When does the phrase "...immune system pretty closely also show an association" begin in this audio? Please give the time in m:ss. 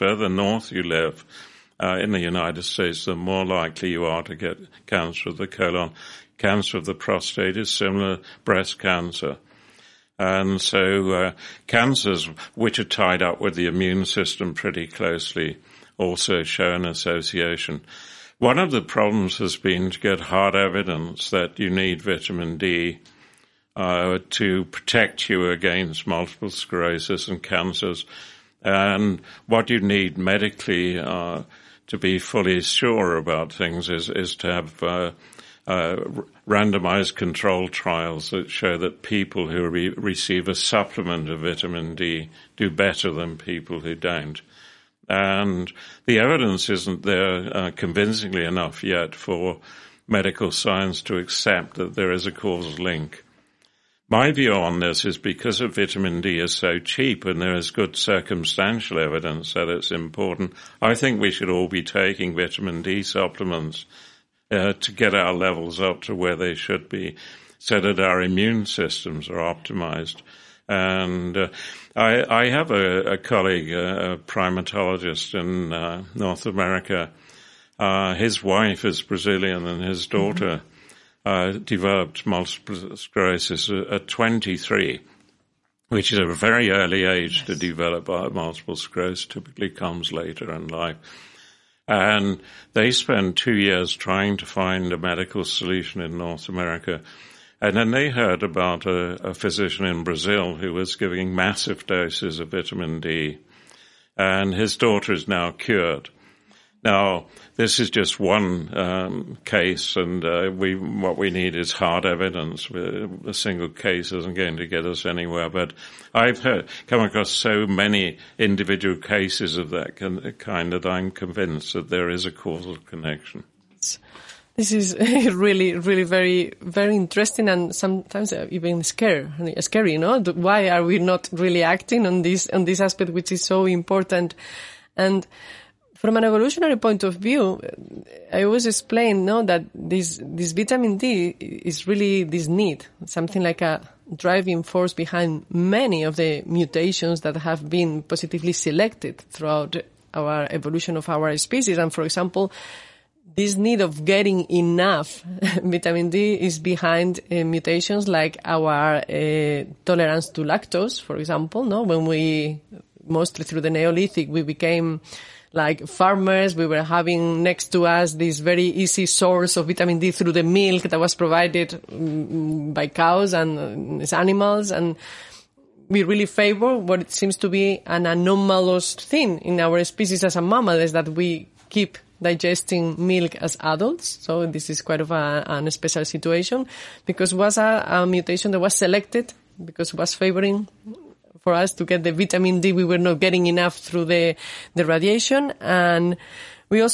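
0:13.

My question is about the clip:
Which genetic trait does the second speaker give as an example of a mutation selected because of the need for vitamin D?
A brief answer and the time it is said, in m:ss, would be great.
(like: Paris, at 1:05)
Tolerance to lactose, at 2:39.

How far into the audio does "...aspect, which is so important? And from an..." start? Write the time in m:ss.
2:12.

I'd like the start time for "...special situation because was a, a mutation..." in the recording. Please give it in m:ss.
3:05.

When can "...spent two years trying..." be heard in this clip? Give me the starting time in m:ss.
1:32.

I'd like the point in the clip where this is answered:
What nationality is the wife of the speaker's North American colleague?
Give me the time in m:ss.
1:19.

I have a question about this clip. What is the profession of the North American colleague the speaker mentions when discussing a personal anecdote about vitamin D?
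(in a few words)
Primatologist.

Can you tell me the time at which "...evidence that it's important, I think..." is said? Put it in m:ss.
0:58.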